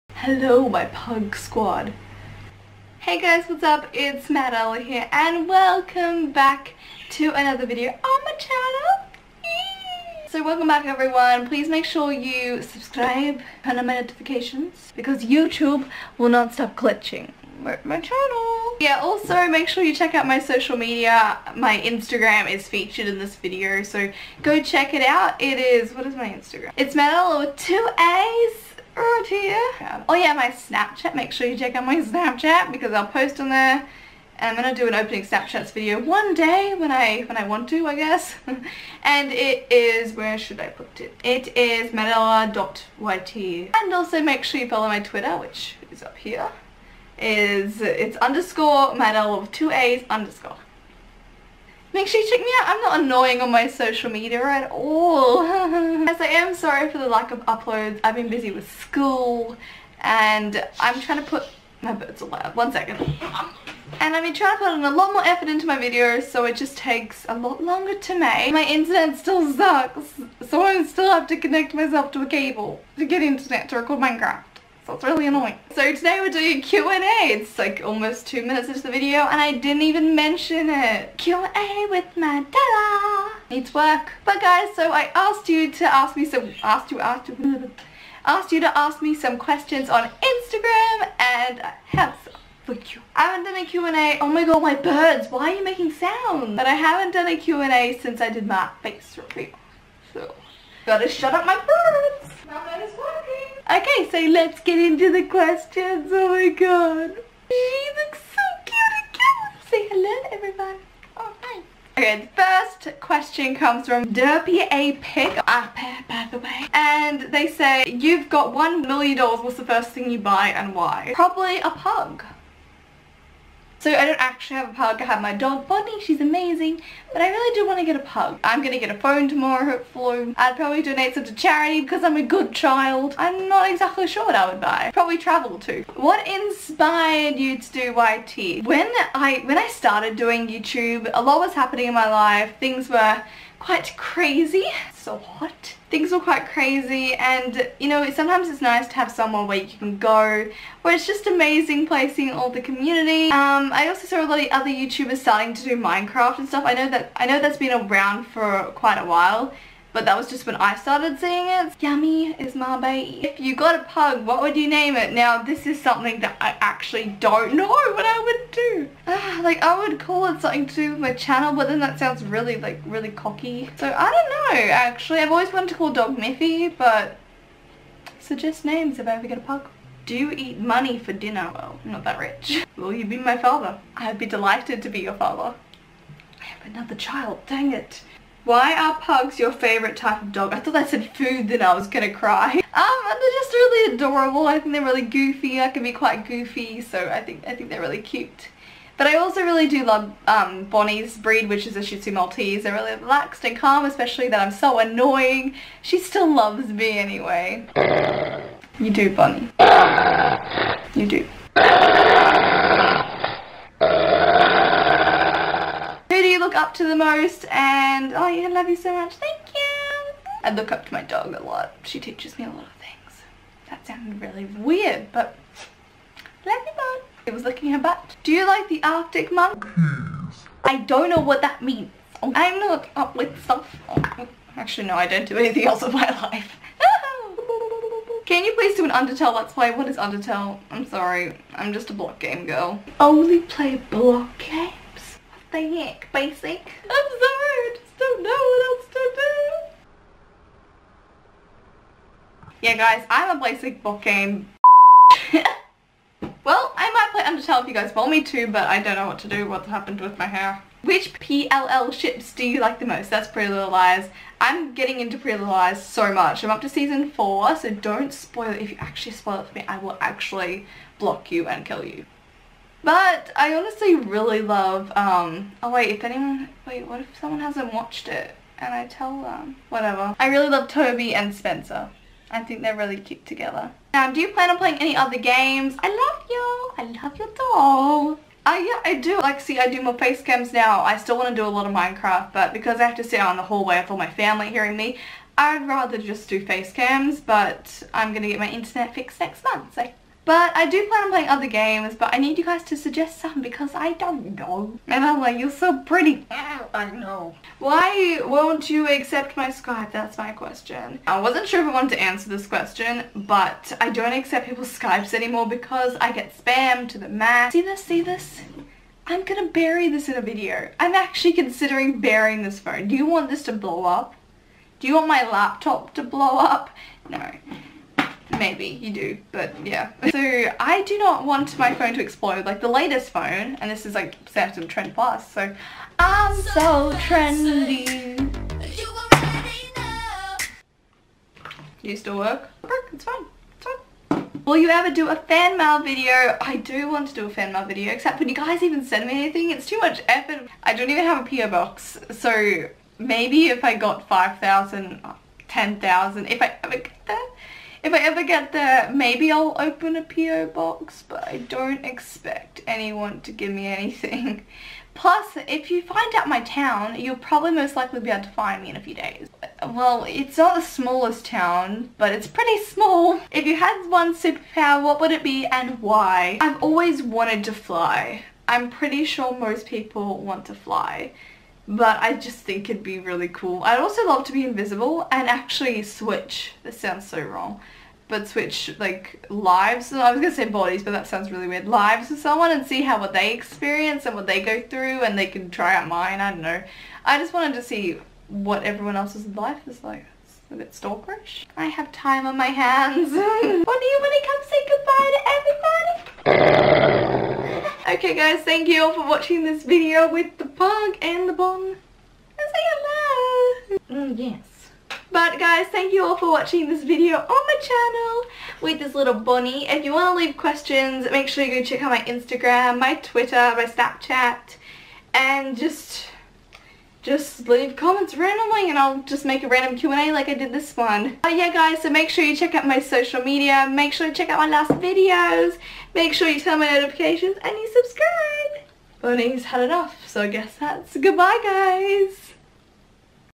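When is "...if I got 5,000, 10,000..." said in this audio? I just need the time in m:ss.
5:53.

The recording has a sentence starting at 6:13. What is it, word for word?
If you had one superpower, what would it be and why?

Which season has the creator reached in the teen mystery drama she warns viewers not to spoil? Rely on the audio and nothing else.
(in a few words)
Season 4.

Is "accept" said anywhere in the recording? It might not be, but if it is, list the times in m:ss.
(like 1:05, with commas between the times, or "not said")
5:08, 5:14.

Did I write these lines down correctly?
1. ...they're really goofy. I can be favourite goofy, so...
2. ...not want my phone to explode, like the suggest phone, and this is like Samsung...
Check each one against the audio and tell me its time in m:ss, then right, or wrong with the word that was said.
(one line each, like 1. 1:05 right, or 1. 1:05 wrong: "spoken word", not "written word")
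1. 3:14 wrong: "quite", not "favourite"
2. 5:30 wrong: "latest", not "suggest".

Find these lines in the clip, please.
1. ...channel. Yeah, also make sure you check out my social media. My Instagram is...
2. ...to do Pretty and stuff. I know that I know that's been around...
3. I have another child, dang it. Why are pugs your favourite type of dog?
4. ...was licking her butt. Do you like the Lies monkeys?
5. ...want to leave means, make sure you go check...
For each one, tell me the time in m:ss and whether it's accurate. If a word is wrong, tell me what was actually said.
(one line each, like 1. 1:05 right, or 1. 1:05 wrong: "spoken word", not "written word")
1. 0:17 right
2. 2:35 wrong: "Minecraft", not "Pretty"
3. 3:06 right
4. 3:47 wrong: "Arctic", not "Lies"
5. 6:59 wrong: "questions", not "means".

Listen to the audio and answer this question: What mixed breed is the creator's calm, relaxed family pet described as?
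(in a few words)
Shih Tzu Maltese.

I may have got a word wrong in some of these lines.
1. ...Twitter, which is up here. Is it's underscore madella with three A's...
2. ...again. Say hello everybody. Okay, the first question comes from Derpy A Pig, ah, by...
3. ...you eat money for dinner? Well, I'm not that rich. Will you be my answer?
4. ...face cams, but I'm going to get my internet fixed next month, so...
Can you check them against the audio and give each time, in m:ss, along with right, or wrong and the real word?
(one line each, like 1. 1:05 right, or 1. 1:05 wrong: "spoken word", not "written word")
1. 0:44 wrong: "two", not "three"
2. 1:49 right
3. 3:00 wrong: "father", not "answer"
4. 4:56 right.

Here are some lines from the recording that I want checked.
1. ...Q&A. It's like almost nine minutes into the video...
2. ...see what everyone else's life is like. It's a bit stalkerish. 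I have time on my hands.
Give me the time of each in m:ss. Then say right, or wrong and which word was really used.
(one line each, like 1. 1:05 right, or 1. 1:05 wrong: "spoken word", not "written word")
1. 1:16 wrong: "two", not "nine"
2. 6:37 right.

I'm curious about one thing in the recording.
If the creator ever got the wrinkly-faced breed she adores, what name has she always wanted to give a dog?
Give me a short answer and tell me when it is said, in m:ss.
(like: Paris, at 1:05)
Miffy, at 2:56.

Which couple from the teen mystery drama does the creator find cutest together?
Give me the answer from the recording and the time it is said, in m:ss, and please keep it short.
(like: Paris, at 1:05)
Toby and Spencer, at 4:40.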